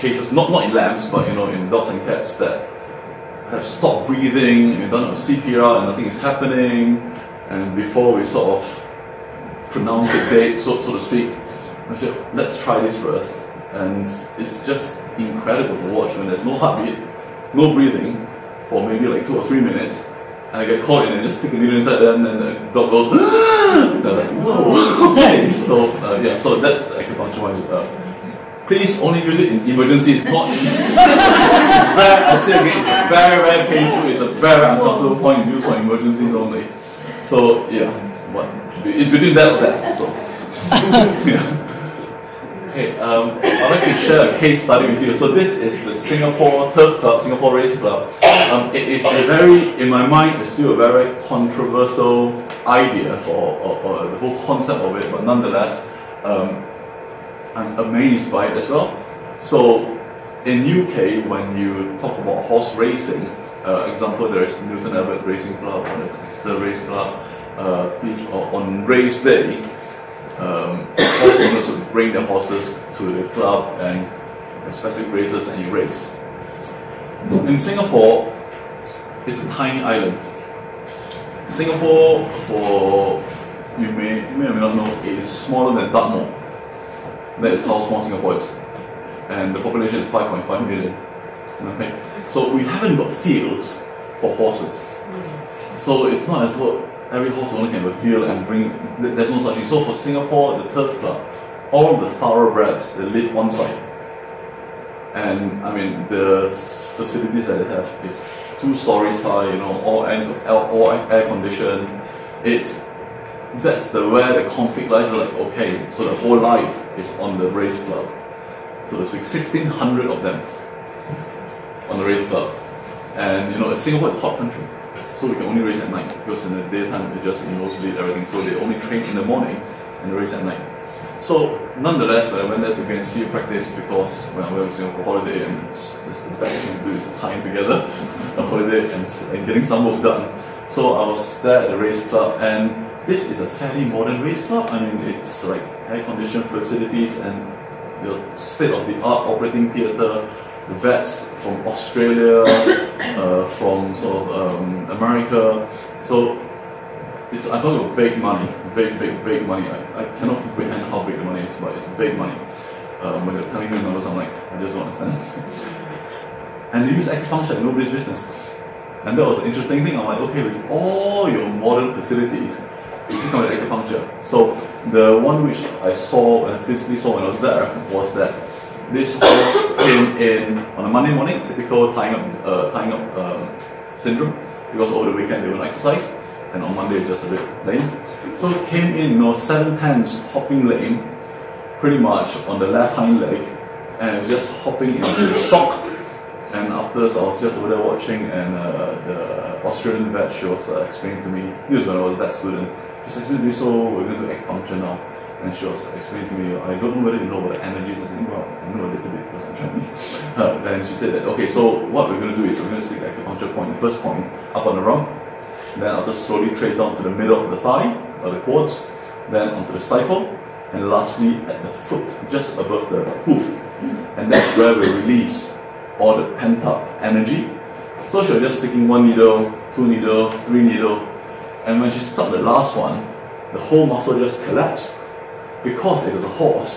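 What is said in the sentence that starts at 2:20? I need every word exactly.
So I was there at the race club, and this is a fairly modern race club.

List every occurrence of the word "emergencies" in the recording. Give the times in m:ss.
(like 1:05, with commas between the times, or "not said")
0:29, 0:35.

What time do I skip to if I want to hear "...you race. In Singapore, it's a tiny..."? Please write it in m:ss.
1:15.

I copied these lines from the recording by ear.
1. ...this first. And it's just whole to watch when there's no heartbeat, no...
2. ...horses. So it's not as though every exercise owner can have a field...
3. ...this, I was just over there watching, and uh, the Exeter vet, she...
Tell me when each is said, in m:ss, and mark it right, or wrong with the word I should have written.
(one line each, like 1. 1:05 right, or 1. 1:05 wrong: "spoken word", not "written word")
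1. 0:12 wrong: "incredible", not "whole"
2. 1:34 wrong: "horse", not "exercise"
3. 3:17 wrong: "Australian", not "Exeter".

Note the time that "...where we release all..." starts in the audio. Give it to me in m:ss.
3:44.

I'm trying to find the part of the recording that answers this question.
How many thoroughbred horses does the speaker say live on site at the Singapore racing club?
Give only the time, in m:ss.
1:59.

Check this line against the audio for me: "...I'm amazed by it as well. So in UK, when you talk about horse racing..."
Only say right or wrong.
right.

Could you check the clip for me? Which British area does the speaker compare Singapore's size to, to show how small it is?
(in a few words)
Dartmoor.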